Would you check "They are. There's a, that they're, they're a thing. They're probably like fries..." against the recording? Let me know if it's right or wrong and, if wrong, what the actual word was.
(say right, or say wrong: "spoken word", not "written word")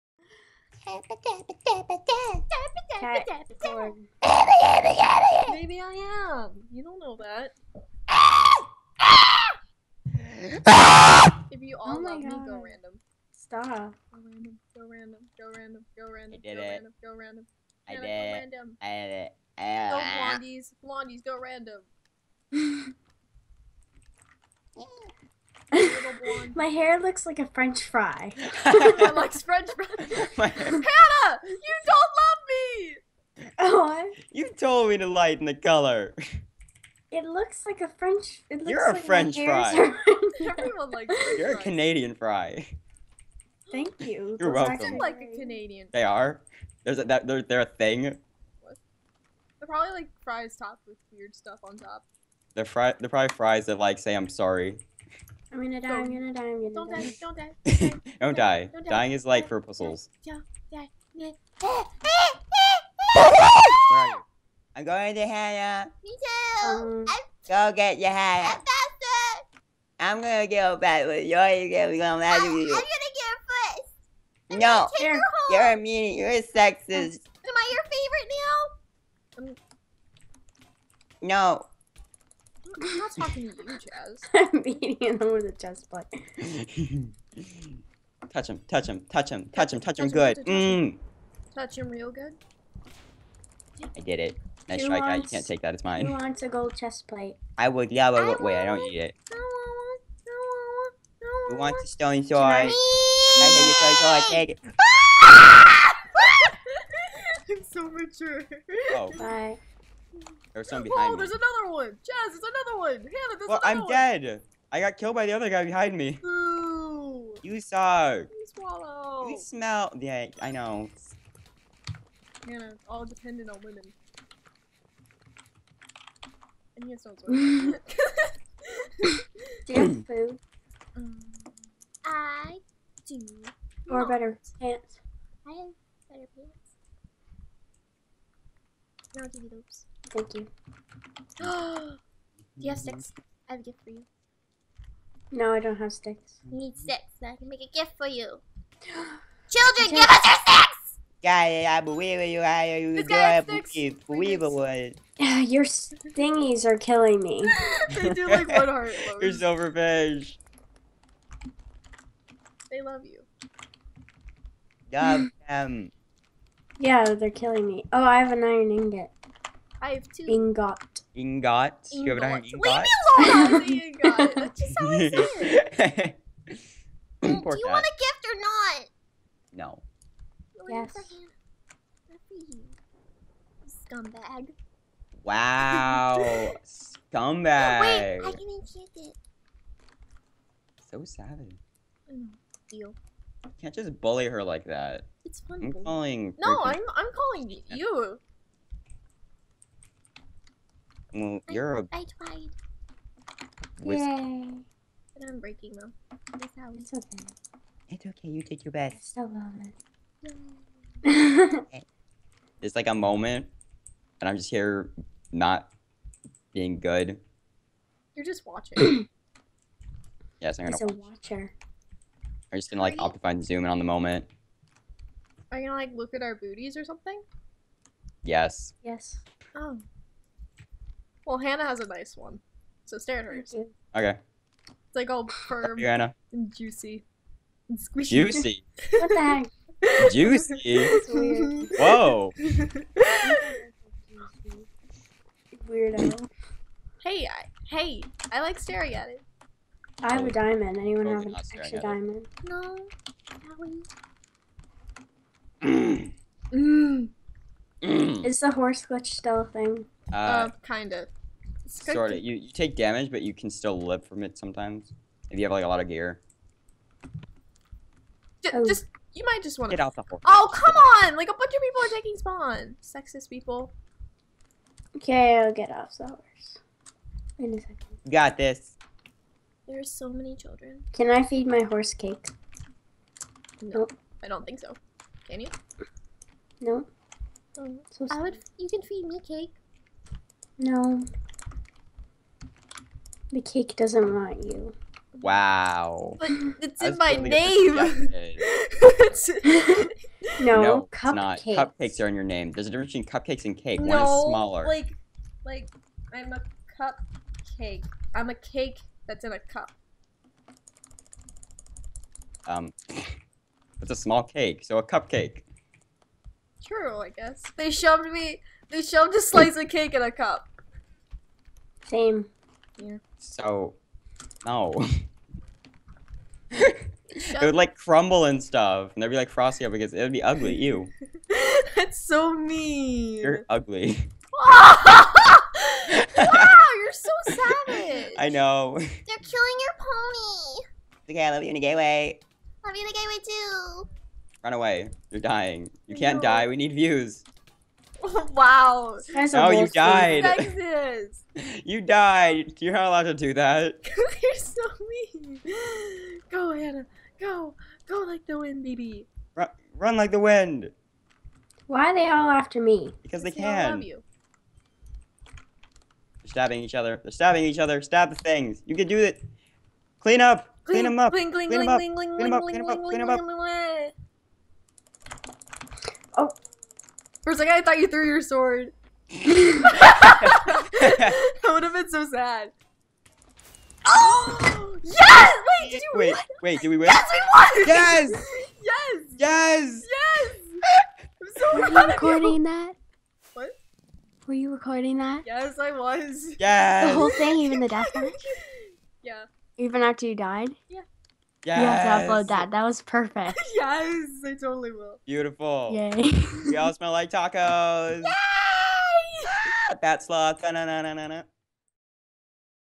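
right.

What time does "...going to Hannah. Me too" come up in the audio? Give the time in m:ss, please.
1:04.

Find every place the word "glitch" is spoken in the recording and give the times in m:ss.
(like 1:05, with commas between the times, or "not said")
4:18.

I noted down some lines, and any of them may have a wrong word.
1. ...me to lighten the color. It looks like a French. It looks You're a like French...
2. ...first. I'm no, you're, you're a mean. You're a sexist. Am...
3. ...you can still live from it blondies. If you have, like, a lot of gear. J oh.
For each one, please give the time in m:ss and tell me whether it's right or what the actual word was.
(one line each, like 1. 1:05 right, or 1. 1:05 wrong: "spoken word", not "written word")
1. 0:34 right
2. 1:13 right
3. 4:23 wrong: "sometimes", not "blondies".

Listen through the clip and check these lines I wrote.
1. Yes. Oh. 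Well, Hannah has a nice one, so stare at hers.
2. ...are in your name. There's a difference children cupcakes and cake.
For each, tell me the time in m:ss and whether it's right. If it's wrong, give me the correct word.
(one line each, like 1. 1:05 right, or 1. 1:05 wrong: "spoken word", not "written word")
1. 3:48 right
2. 5:01 wrong: "between", not "children".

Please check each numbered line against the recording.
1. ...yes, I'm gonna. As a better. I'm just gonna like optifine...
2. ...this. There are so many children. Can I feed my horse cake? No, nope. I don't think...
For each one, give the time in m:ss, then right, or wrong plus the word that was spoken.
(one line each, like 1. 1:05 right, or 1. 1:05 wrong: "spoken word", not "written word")
1. 3:40 wrong: "watcher", not "better"
2. 4:38 right.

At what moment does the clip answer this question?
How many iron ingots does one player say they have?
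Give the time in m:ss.
2:49.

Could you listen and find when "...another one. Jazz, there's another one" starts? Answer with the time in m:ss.
1:51.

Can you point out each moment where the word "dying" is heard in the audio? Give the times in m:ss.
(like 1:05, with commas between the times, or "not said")
0:58, 5:45.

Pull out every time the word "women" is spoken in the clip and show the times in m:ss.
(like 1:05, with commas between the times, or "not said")
2:03.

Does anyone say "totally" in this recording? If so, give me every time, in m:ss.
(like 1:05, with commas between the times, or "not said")
6:44.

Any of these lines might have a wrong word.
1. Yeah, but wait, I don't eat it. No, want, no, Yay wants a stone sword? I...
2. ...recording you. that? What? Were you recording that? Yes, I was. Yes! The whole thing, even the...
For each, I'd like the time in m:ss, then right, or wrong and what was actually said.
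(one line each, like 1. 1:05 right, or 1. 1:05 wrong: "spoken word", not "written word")
1. 1:37 wrong: "Who", not "Yay"
2. 6:31 right.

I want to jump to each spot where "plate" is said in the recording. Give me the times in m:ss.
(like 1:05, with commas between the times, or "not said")
1:25, 1:37.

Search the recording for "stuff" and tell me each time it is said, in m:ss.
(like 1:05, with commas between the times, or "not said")
0:51, 5:28.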